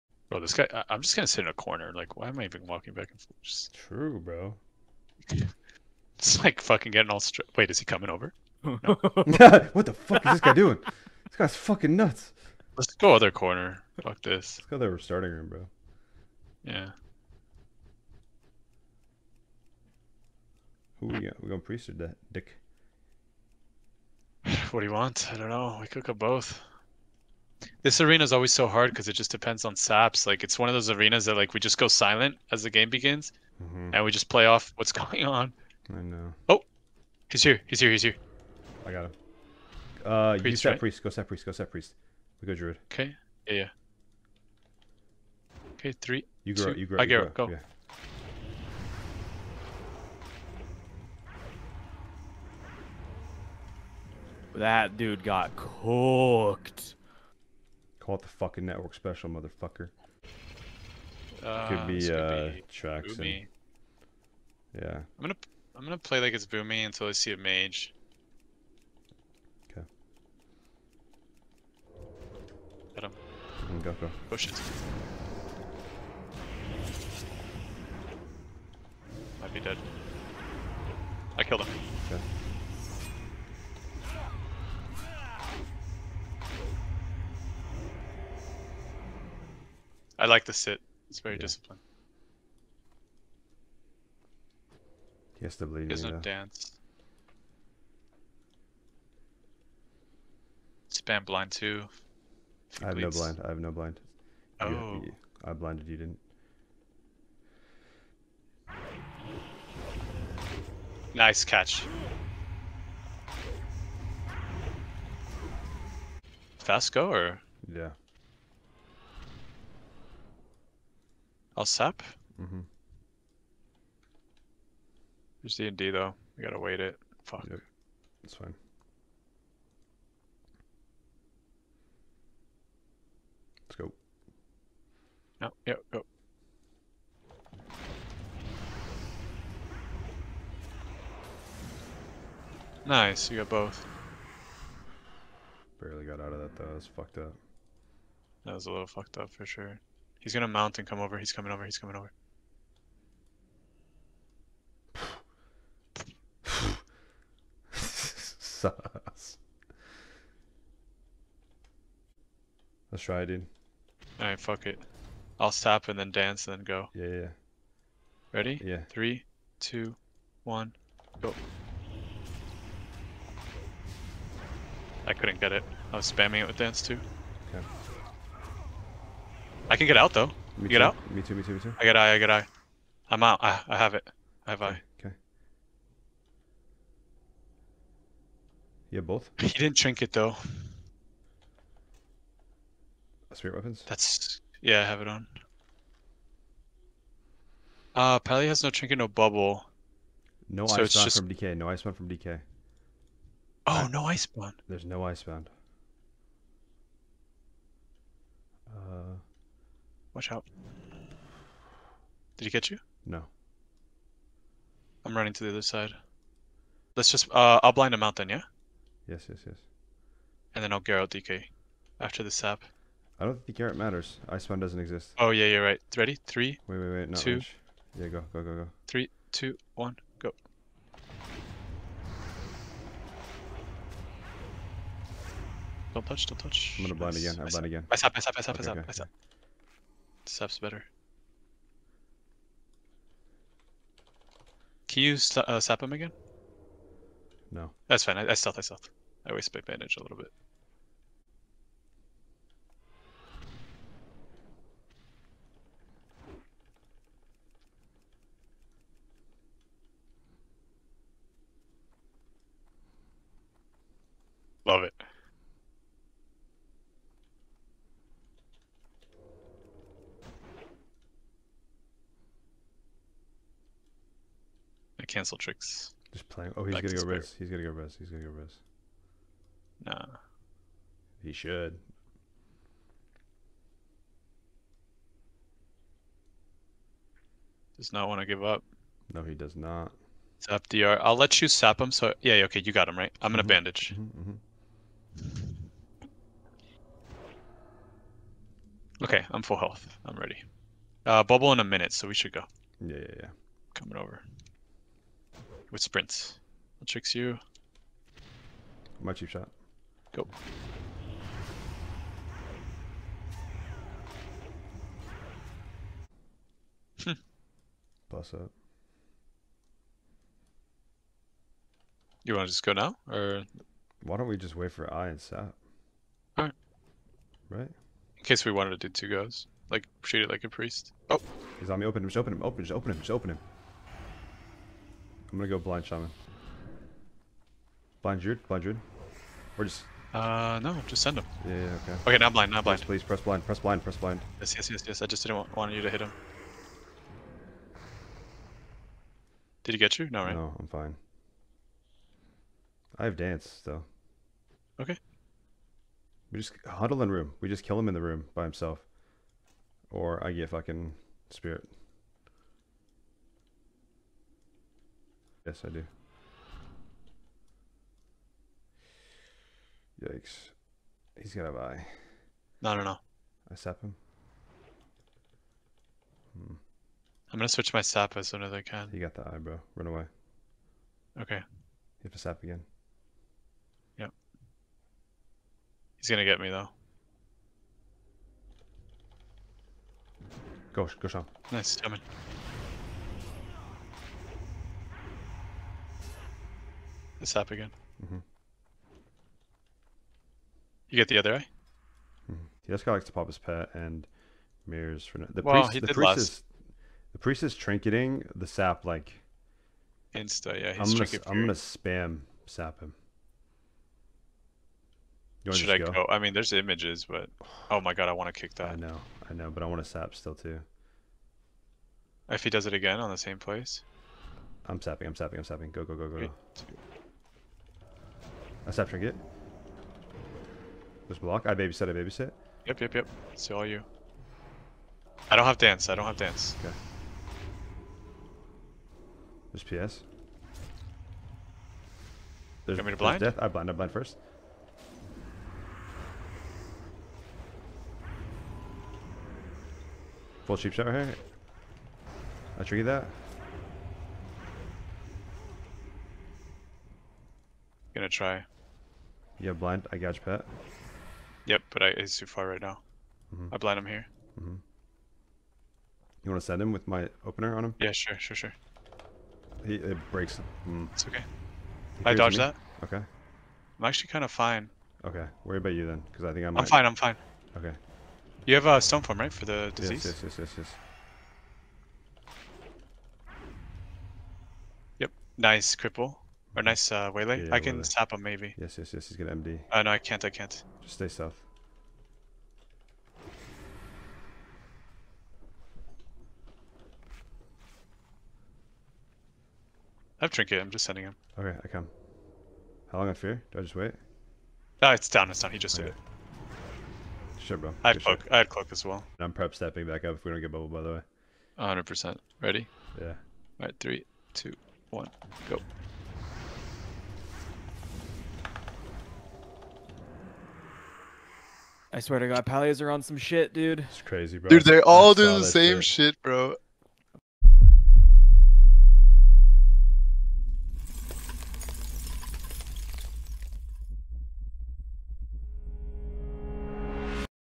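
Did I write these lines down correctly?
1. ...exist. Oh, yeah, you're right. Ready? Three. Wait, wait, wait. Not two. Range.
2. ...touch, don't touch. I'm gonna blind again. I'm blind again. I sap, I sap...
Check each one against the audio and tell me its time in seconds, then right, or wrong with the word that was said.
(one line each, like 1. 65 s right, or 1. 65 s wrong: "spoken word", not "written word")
1. 224 s right
2. 236 s right.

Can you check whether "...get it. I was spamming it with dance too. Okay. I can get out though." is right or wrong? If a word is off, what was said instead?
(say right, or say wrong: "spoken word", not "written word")
right.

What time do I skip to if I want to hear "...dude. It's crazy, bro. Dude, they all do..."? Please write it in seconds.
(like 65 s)
523 s.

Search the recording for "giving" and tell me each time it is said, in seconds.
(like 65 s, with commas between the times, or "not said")
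not said.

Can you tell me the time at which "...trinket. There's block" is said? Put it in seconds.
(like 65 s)
428 s.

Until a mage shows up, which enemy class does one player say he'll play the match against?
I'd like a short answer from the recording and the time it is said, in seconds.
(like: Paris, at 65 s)
Boomy, at 66 s.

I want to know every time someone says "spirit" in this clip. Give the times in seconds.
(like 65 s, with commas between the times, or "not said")
193 s, 361 s.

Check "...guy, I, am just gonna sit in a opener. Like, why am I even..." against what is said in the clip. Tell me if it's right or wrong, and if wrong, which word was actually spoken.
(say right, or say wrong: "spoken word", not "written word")
wrong: "corner", not "opener".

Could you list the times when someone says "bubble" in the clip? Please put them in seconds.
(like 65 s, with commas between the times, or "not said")
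199 s, 301 s, 510 s.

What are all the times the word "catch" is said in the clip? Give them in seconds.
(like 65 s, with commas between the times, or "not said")
111 s, 212 s.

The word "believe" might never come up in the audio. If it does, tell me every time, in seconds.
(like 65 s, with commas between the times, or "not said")
95 s.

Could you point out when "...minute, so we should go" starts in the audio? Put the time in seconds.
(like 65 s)
301 s.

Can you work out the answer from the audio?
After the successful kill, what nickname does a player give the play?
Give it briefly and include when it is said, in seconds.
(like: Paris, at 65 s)
network special, at 58 s.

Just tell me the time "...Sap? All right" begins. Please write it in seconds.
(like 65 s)
325 s.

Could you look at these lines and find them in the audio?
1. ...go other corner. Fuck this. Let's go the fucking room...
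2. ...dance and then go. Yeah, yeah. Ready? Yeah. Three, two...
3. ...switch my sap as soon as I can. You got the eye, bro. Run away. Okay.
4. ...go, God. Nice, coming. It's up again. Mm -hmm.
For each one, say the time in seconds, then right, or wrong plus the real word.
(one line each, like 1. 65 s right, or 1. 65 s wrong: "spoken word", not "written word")
1. 12 s wrong: "starting", not "fucking"
2. 166 s right
3. 377 s right
4. 391 s wrong: "Sean", not "God".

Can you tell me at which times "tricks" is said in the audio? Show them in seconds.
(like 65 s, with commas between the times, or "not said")
275 s, 306 s.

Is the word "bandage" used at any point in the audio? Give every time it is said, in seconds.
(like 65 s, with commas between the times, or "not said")
249 s, 293 s.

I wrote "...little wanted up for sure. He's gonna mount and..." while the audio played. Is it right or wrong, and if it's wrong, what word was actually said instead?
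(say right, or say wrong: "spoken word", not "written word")
wrong: "fucked", not "wanted".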